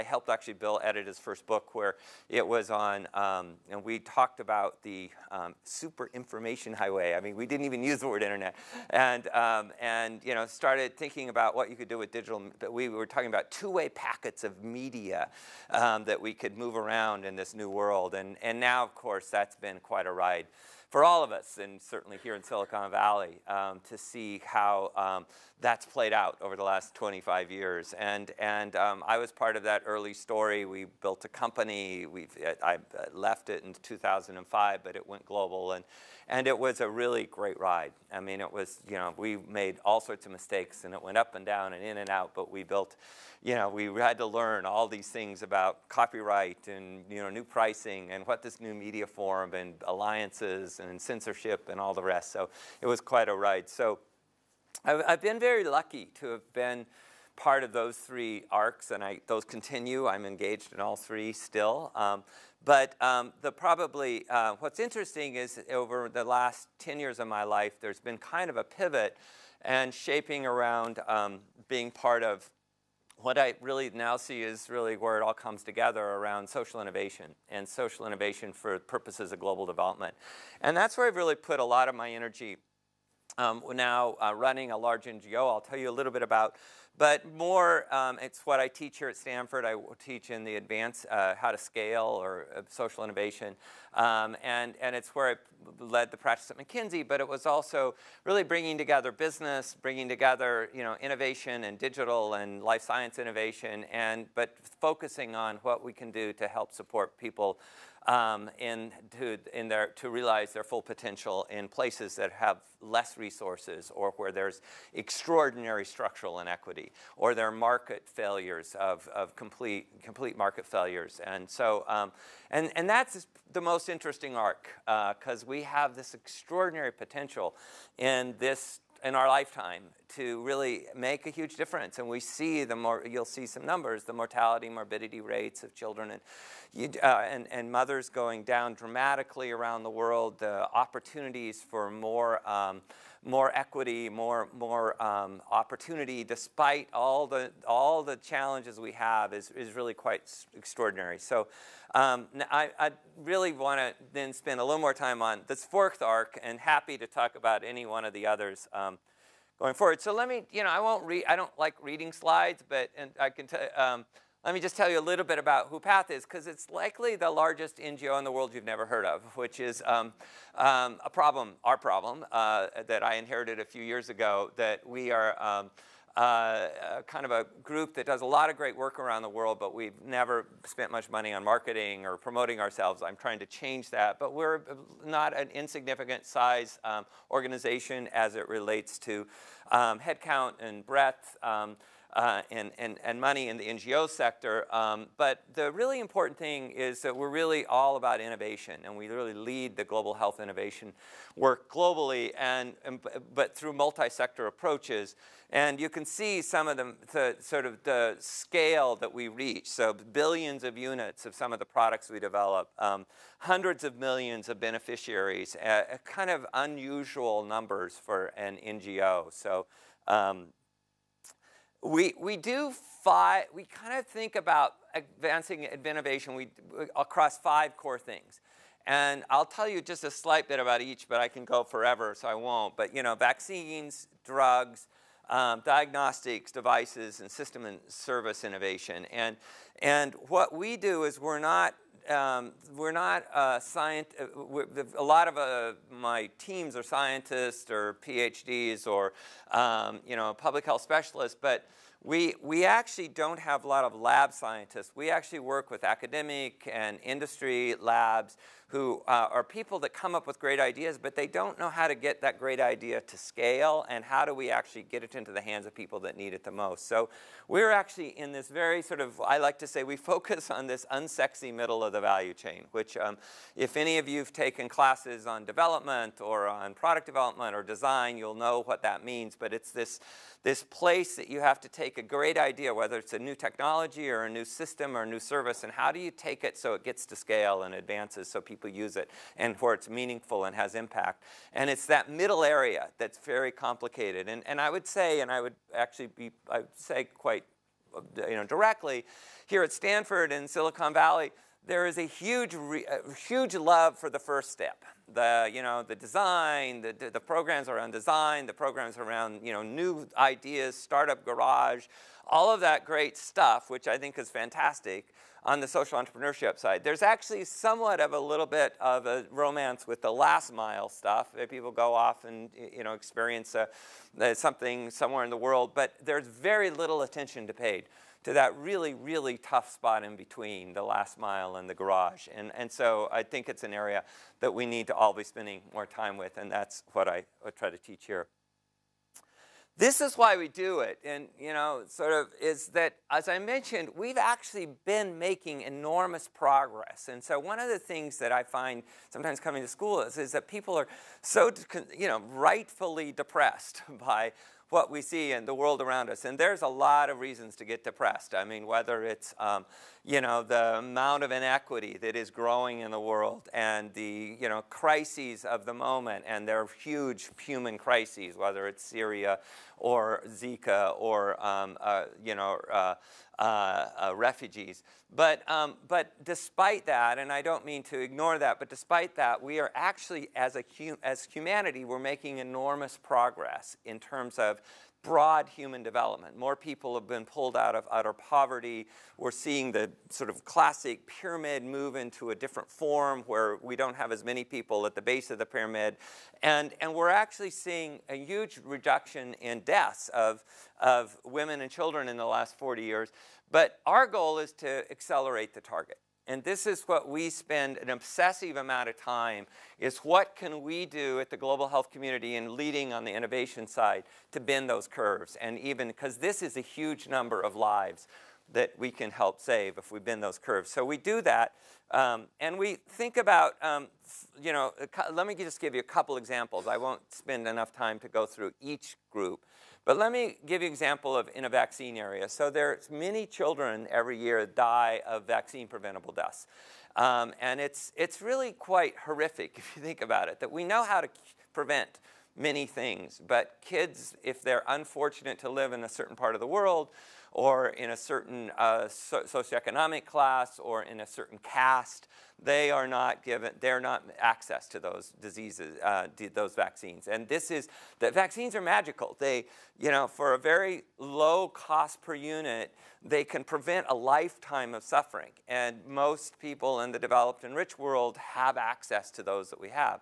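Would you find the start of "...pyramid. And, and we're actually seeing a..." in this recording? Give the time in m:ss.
6:35.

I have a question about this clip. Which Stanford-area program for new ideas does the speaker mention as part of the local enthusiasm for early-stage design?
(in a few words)
startup garage.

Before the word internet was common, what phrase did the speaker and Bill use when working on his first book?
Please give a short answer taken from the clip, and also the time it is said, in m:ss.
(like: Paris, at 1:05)
super information highway, at 0:05.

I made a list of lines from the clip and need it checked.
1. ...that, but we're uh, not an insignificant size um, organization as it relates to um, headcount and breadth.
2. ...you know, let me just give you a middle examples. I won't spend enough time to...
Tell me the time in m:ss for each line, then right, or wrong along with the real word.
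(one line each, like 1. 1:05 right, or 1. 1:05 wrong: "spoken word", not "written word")
1. 3:03 right
2. 7:04 wrong: "couple", not "middle".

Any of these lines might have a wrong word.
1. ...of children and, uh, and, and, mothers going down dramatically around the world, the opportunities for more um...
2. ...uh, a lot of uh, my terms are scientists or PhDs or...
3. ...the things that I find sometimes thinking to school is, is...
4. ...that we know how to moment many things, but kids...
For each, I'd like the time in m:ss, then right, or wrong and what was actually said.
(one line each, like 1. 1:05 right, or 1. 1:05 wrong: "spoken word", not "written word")
1. 2:15 right
2. 4:04 wrong: "teams", not "terms"
3. 5:47 wrong: "coming", not "thinking"
4. 7:20 wrong: "prevent", not "moment".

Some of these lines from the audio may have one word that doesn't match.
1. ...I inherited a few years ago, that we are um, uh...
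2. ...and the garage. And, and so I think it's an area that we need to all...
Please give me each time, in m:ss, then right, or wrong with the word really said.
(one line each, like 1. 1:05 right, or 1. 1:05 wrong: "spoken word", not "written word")
1. 2:53 right
2. 5:31 right.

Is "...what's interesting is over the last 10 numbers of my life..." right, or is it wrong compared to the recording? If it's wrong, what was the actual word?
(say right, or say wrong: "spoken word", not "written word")
wrong: "years", not "numbers".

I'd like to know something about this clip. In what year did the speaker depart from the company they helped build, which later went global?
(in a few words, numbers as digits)
2005.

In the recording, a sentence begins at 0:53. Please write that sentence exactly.
So I've, I've been very lucky to have been part of those three arcs and I, those continue.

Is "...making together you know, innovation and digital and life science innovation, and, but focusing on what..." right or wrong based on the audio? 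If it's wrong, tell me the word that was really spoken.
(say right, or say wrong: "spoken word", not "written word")
wrong: "bringing", not "making".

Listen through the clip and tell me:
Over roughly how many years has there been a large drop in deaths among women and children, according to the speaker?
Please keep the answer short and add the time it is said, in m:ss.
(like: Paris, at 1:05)
40, at 6:42.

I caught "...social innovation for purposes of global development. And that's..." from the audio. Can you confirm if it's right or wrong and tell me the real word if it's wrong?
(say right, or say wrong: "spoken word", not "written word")
right.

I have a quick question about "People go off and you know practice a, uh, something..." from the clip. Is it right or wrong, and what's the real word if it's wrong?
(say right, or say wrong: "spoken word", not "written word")
wrong: "experience", not "practice".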